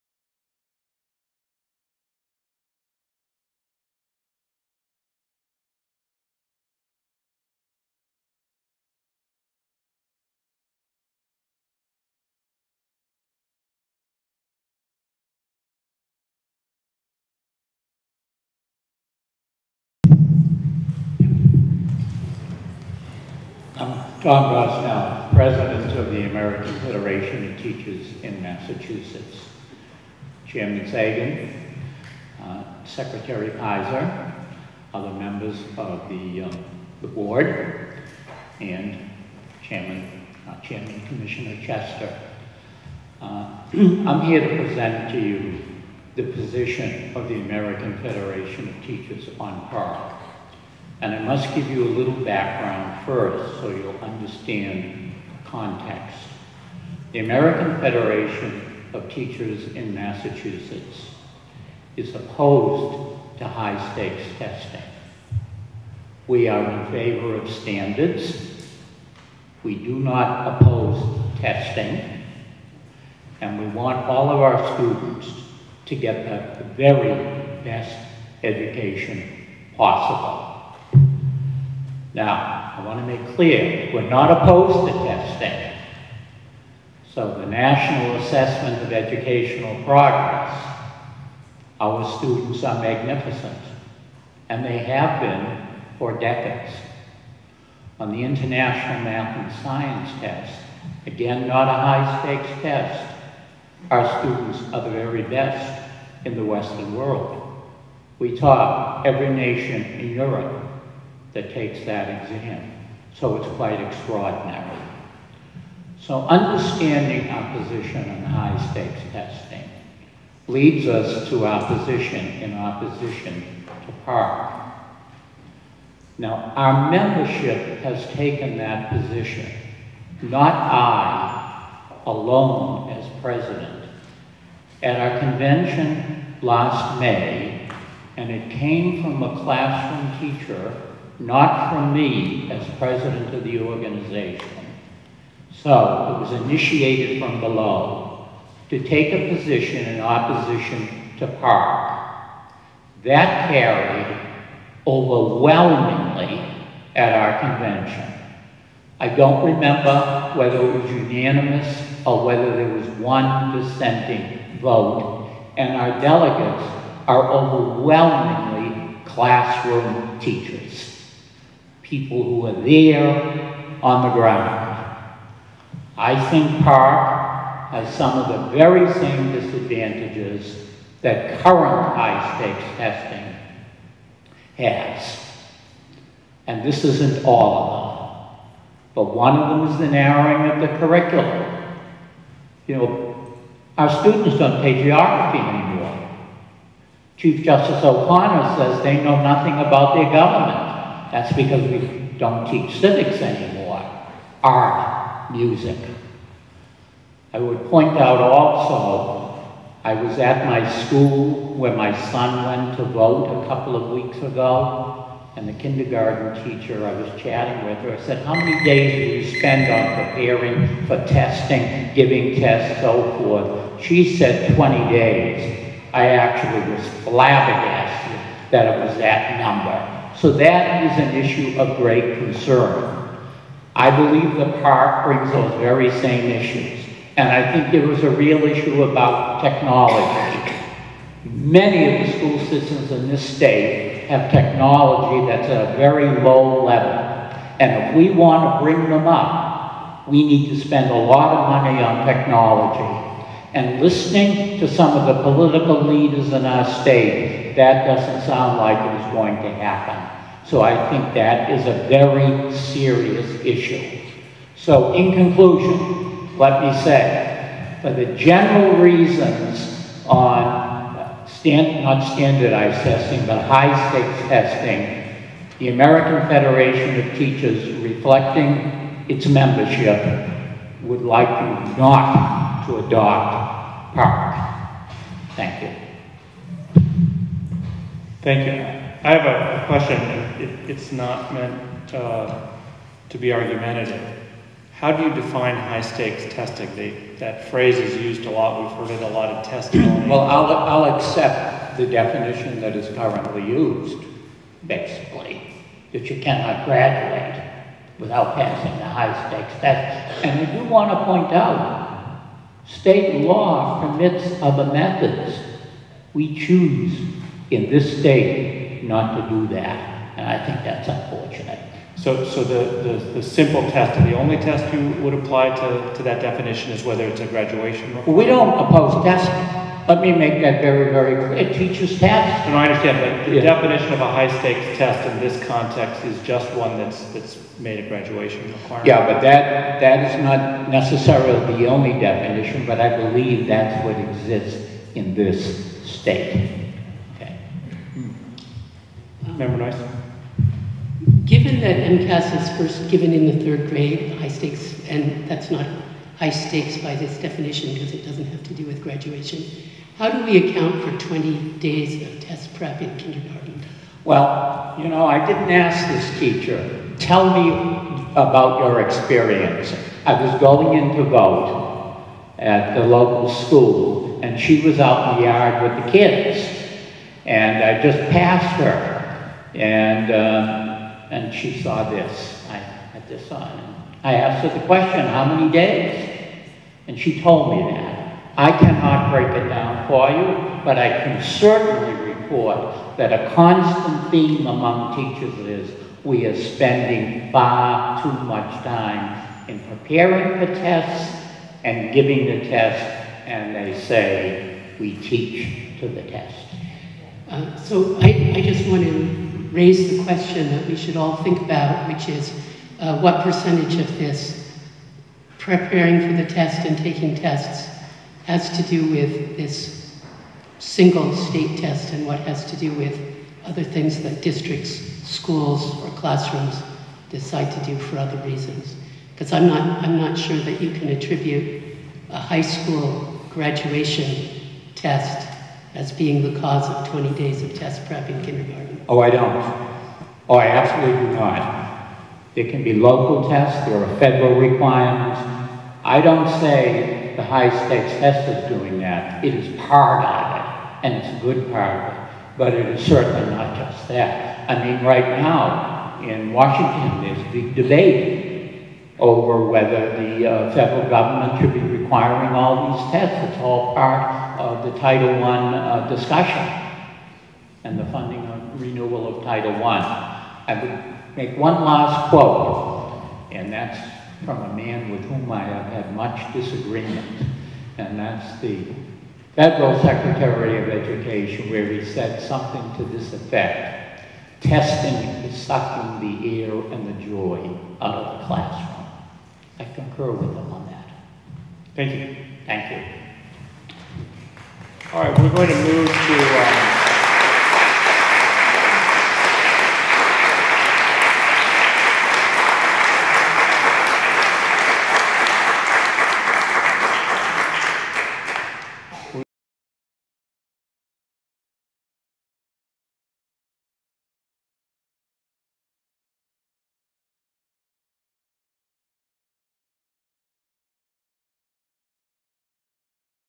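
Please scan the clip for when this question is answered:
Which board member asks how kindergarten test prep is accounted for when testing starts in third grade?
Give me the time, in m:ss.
5:49.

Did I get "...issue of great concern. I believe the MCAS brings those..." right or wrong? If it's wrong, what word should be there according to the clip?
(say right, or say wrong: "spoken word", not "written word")
wrong: "PARCC", not "MCAS".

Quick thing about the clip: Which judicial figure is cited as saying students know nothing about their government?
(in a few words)
Chief Justice O'Connor.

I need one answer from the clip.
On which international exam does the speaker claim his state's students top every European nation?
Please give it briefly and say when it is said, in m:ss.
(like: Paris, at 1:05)
International Math and Science Test, at 1:38.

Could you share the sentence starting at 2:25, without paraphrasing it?
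So it was initiated from below to take a position in opposition to PARCC.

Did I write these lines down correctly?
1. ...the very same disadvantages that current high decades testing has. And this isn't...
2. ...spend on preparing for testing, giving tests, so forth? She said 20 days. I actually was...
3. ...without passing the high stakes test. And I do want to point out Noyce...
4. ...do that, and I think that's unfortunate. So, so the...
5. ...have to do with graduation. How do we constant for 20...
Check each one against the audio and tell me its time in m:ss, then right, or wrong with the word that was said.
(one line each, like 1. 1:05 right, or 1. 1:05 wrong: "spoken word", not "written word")
1. 2:58 wrong: "stakes", not "decades"
2. 3:39 right
3. 5:07 wrong: "State", not "Noyce"
4. 5:19 right
5. 5:58 wrong: "account", not "constant".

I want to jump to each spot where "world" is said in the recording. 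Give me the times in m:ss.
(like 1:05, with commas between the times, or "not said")
1:46.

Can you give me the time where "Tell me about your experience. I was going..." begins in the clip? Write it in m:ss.
6:06.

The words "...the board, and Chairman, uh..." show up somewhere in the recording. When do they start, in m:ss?
0:37.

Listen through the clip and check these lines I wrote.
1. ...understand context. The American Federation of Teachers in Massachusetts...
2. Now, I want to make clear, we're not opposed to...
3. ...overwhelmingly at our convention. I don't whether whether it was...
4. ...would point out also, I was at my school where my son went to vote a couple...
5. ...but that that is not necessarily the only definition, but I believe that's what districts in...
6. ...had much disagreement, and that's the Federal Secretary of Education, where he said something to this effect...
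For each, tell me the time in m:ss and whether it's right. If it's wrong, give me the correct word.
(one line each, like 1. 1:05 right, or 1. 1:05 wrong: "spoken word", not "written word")
1. 0:54 right
2. 1:22 right
3. 2:34 wrong: "remember", not "whether"
4. 3:27 right
5. 5:39 wrong: "exists", not "districts"
6. 7:55 right.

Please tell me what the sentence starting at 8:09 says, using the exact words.
I concur with him on that.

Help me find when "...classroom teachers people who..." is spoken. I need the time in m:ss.
2:49.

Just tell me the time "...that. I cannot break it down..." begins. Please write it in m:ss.
6:27.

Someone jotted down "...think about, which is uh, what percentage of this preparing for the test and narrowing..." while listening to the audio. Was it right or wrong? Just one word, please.
wrong.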